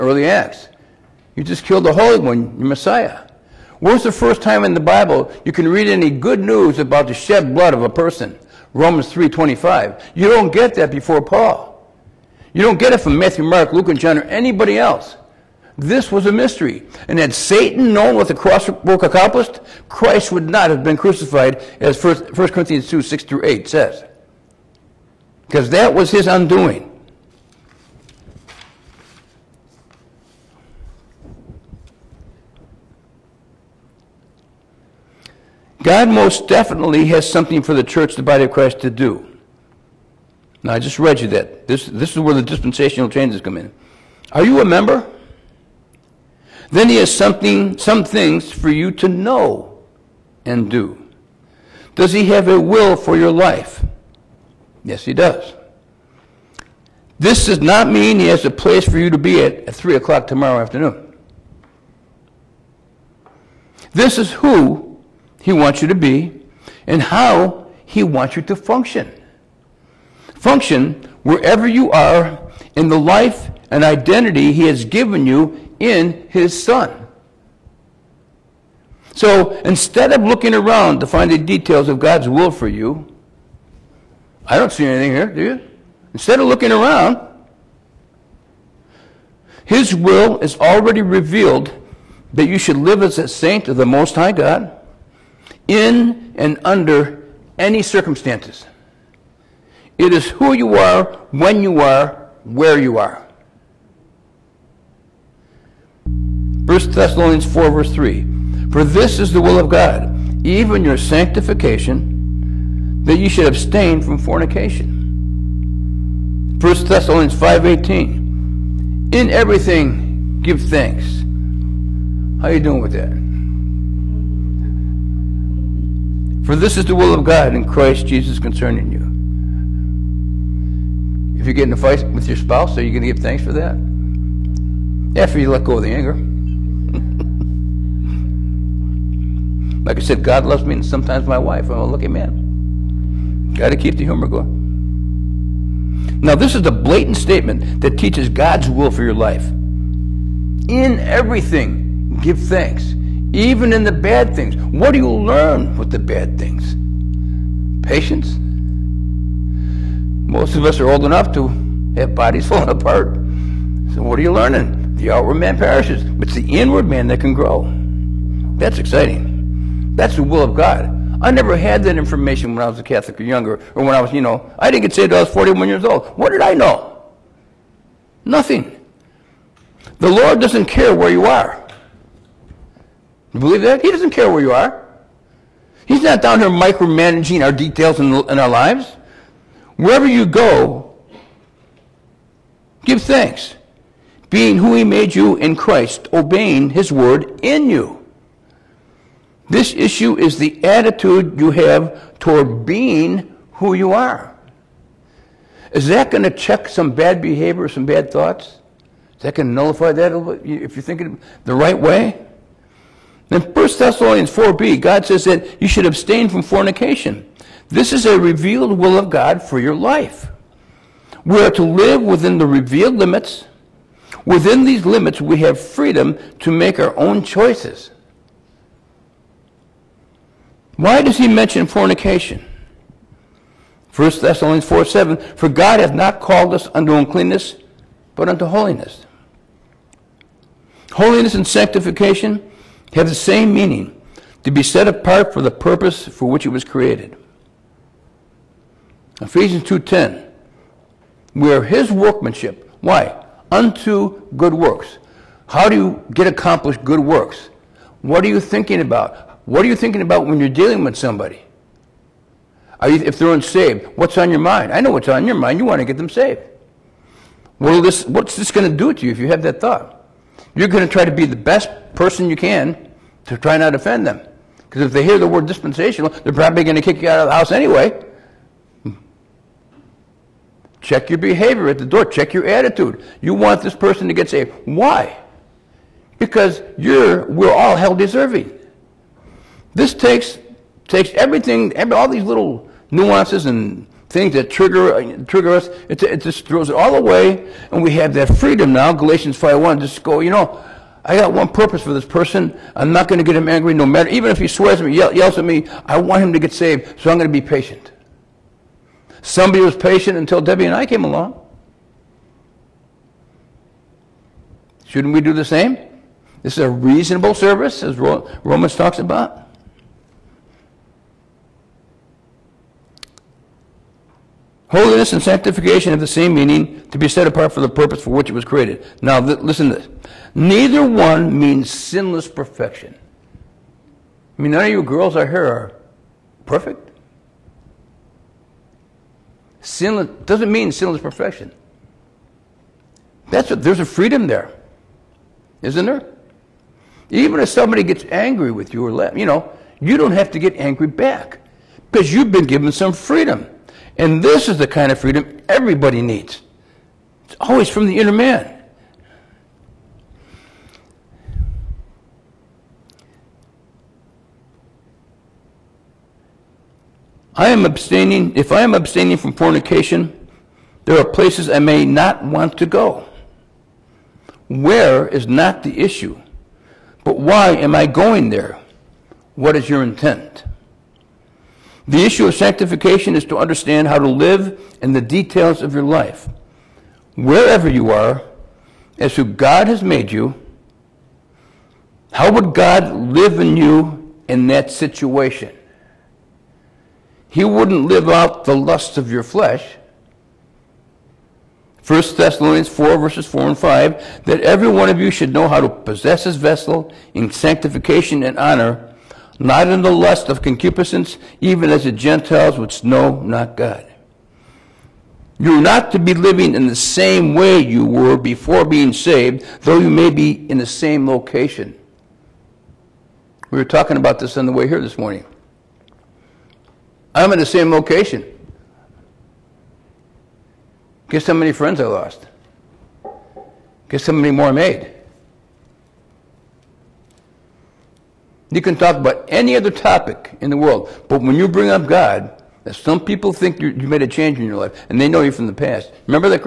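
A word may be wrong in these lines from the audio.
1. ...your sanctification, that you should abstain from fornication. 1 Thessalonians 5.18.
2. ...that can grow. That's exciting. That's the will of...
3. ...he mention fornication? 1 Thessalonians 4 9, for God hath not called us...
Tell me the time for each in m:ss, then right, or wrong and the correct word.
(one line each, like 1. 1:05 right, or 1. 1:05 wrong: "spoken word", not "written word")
1. 1:50 right
2. 2:47 right
3. 3:51 wrong: "7", not "9".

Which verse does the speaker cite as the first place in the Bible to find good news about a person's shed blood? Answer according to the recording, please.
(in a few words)
Romans 3:25.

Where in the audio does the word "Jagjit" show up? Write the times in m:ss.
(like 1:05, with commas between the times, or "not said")
not said.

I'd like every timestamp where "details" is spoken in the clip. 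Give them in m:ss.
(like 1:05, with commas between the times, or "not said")
1:21, 3:07, 6:24.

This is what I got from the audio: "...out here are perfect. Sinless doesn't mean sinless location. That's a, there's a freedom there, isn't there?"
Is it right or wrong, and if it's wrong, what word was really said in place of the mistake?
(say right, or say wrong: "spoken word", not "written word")
wrong: "perfection", not "location".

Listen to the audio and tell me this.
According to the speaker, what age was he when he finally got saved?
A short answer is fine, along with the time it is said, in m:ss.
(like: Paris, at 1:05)
41, at 2:55.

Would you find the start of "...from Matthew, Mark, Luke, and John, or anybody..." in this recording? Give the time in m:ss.
0:13.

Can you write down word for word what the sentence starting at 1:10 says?
Function wherever you are in the life and identity He has given you in His Son.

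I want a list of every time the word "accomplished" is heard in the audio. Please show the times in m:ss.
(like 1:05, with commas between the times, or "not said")
0:19, 4:16.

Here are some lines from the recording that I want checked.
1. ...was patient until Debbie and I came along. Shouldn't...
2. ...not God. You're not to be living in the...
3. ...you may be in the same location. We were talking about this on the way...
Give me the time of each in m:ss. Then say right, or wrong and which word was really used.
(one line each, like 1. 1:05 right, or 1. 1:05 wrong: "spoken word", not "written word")
1. 5:09 right
2. 6:53 right
3. 6:59 right.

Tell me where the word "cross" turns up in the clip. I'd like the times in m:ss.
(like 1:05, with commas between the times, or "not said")
0:18.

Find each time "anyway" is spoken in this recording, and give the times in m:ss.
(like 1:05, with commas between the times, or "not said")
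4:37.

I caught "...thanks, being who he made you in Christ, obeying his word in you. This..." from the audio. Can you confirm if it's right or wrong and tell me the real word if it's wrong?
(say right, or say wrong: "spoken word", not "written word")
right.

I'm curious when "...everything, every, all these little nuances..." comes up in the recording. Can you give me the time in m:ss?
4:51.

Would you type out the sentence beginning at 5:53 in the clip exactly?
And this is the kind of freedom everybody needs.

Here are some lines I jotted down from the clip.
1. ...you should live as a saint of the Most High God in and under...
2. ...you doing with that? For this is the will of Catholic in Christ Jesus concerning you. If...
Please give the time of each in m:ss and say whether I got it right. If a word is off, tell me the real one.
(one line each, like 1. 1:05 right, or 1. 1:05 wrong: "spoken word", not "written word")
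1. 1:32 right
2. 2:02 wrong: "God", not "Catholic".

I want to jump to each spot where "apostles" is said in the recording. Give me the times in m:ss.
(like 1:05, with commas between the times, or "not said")
not said.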